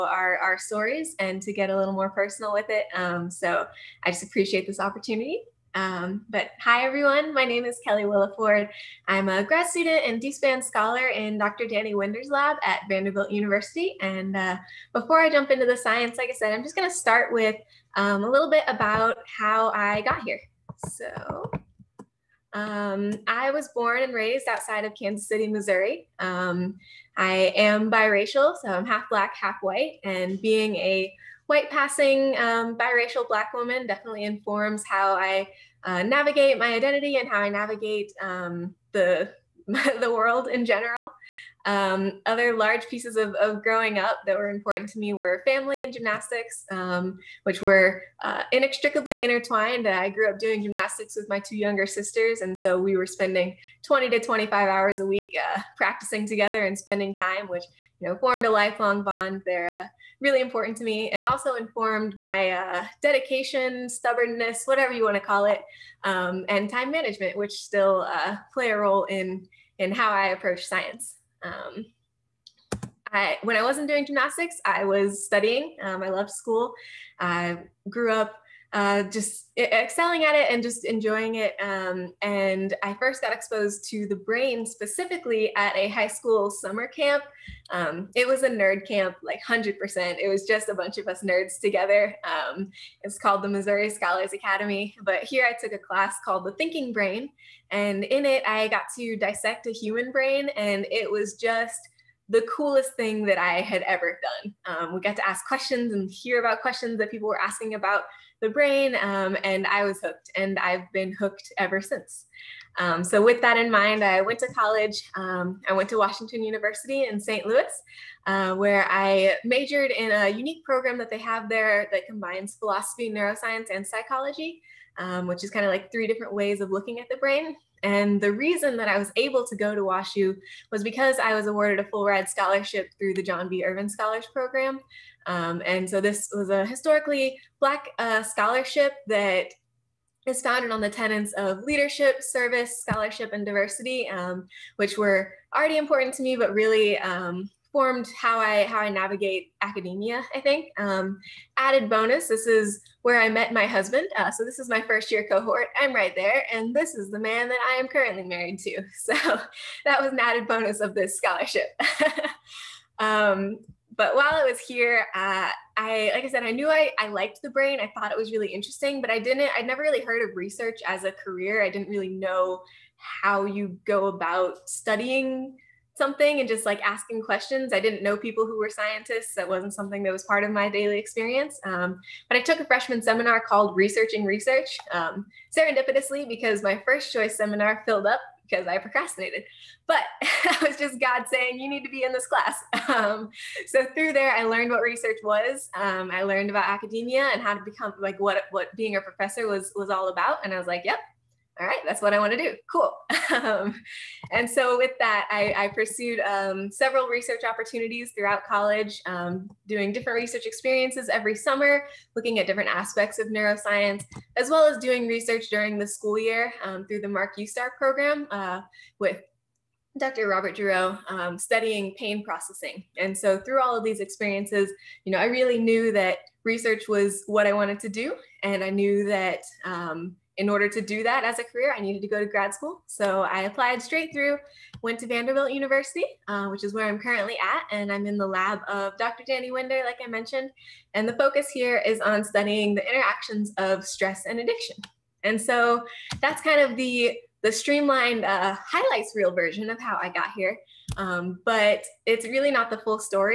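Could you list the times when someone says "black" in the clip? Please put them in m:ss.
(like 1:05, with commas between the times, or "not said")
0:29, 0:33, 2:17.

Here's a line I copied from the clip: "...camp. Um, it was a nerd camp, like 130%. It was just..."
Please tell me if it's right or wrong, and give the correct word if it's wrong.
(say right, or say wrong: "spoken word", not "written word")
wrong: "100", not "130".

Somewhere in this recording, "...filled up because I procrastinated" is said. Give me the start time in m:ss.
3:07.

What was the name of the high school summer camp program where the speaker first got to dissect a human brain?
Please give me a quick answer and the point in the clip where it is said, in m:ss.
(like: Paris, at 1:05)
Missouri Scholars Academy, at 1:33.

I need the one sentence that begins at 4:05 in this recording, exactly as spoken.
And so that's kind of the the streamlined uh, highlights reel version of how I got here.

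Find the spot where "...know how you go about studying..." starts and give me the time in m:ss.
2:52.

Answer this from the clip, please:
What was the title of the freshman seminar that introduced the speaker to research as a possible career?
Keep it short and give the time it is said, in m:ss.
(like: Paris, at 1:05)
Researching Research, at 3:03.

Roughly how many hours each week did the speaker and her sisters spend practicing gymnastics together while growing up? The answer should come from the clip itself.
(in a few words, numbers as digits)
20 to 25.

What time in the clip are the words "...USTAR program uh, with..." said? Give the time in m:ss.
3:37.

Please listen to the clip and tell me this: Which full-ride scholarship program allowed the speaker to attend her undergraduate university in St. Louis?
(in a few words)
John B. Irvin Scholars Program.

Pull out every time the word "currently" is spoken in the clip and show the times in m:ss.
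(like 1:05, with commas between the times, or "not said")
2:37, 3:56.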